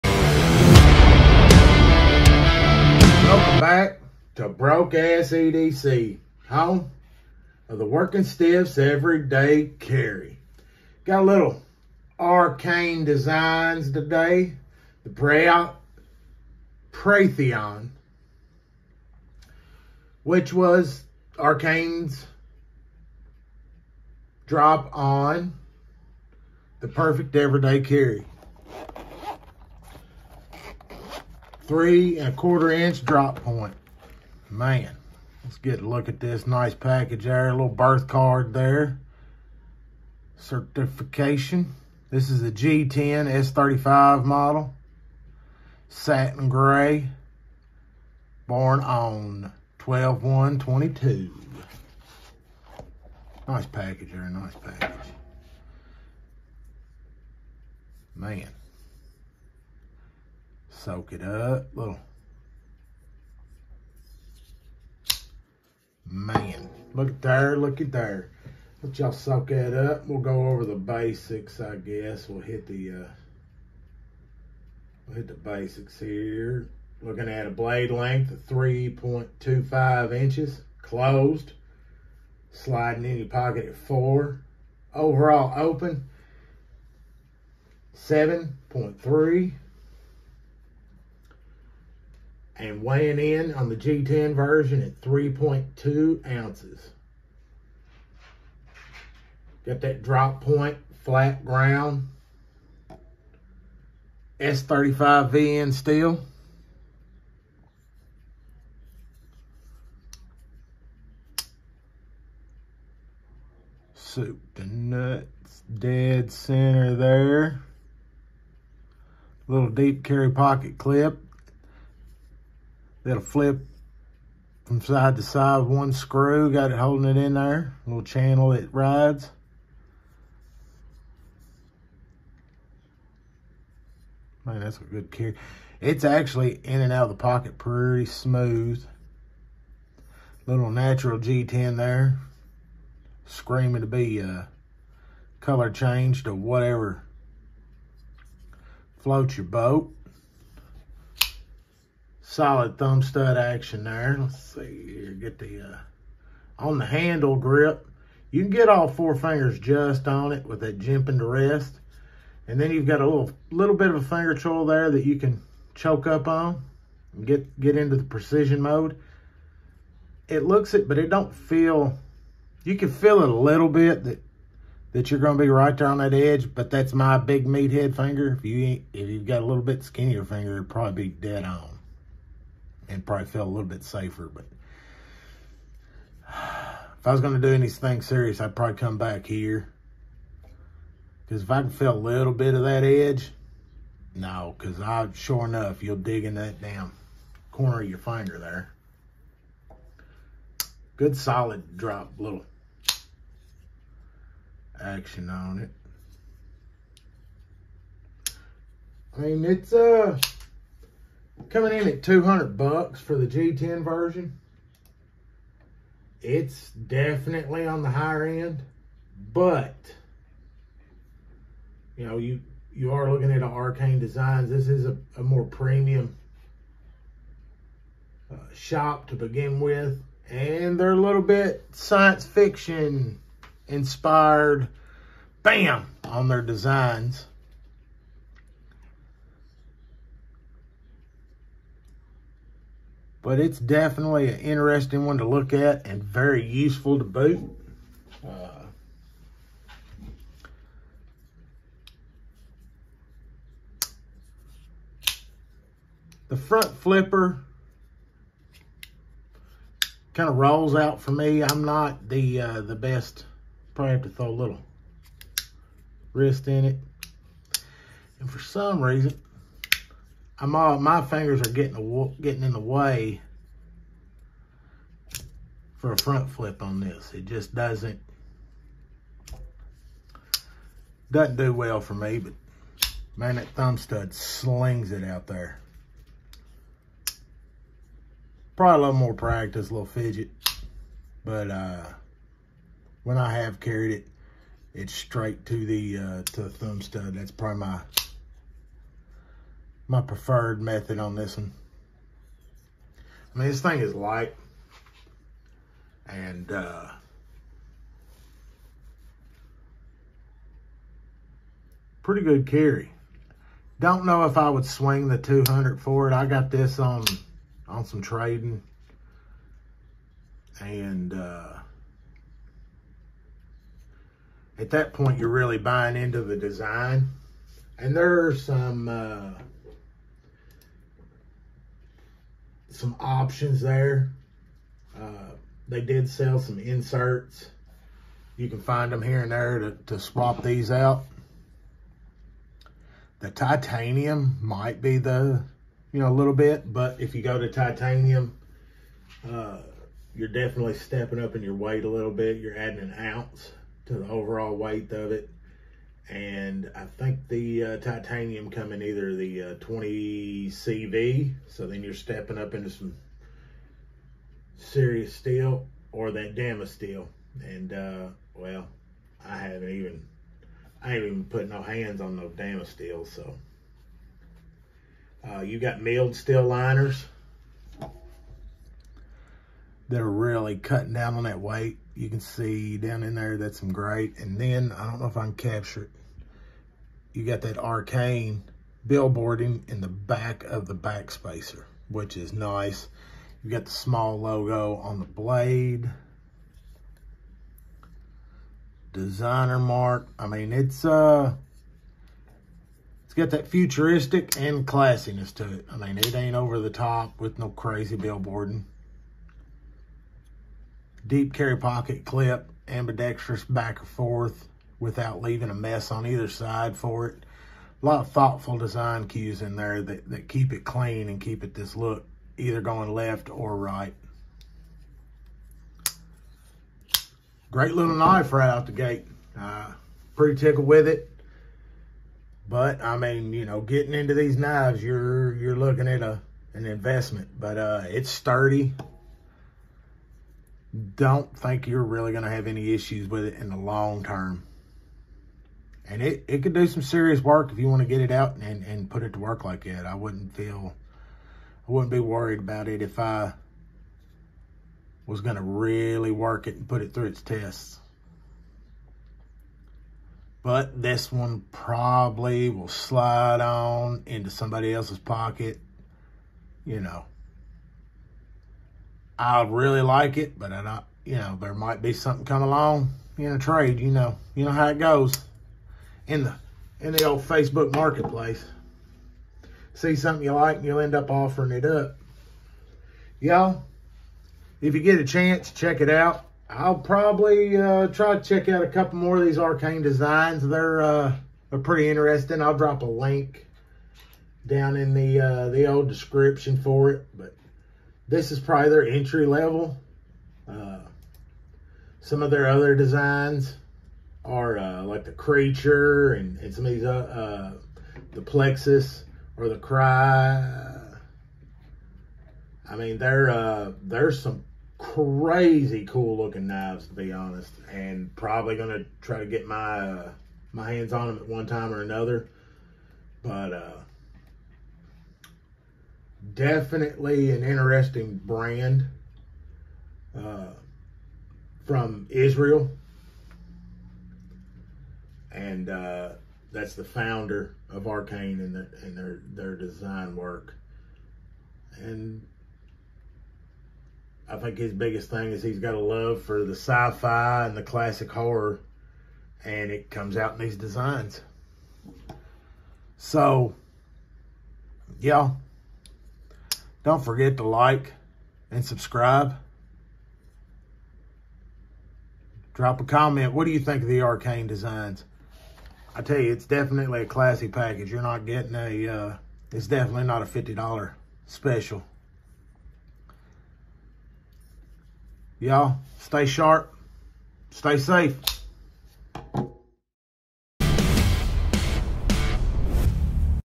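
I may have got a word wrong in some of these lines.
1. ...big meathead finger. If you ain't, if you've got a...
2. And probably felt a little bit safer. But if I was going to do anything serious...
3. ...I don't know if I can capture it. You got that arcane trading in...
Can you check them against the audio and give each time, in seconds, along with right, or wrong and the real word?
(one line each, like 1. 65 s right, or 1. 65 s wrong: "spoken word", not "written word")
1. 177 s right
2. 182 s right
3. 384 s wrong: "billboarding", not "trading".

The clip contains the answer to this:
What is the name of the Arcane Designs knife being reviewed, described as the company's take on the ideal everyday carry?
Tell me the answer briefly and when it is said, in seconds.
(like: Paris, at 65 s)
Preytheon, at 16 s.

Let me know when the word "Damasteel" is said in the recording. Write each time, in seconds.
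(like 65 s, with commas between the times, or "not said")
366 s, 372 s.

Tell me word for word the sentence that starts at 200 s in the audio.
Good solid drop, little action on it.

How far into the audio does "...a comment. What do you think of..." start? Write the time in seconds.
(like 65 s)
562 s.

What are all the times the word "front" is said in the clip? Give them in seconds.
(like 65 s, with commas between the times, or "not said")
256 s, 275 s.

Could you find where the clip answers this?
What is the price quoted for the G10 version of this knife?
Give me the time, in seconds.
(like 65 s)
212 s.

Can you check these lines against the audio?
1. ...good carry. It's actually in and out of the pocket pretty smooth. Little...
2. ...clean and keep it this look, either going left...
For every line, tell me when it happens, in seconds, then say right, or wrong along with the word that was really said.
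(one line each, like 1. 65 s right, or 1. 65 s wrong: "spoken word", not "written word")
1. 134 s right
2. 420 s right.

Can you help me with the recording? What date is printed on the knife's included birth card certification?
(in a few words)
12-1-22.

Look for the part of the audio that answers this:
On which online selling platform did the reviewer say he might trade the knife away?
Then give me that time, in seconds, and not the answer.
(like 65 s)
477 s.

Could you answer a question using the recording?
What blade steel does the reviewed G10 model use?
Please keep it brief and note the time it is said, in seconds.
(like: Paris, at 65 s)
S35VN, at 104 s.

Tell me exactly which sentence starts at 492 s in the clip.
I'll drop a link down in the uh, the old description for it, but this is probably their entry level.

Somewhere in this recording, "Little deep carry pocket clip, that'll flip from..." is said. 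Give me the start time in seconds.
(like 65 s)
119 s.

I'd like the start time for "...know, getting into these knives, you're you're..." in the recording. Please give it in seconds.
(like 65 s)
433 s.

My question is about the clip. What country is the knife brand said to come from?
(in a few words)
Israel.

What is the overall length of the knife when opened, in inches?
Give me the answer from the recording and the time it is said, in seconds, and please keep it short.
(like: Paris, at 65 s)
7.3, at 87 s.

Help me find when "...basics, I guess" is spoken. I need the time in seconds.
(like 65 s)
70 s.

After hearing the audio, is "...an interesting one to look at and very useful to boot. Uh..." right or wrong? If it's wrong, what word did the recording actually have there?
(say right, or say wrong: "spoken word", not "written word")
right.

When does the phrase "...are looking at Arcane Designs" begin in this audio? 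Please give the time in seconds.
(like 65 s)
222 s.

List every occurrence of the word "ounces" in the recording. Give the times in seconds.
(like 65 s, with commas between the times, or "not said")
96 s, 352 s.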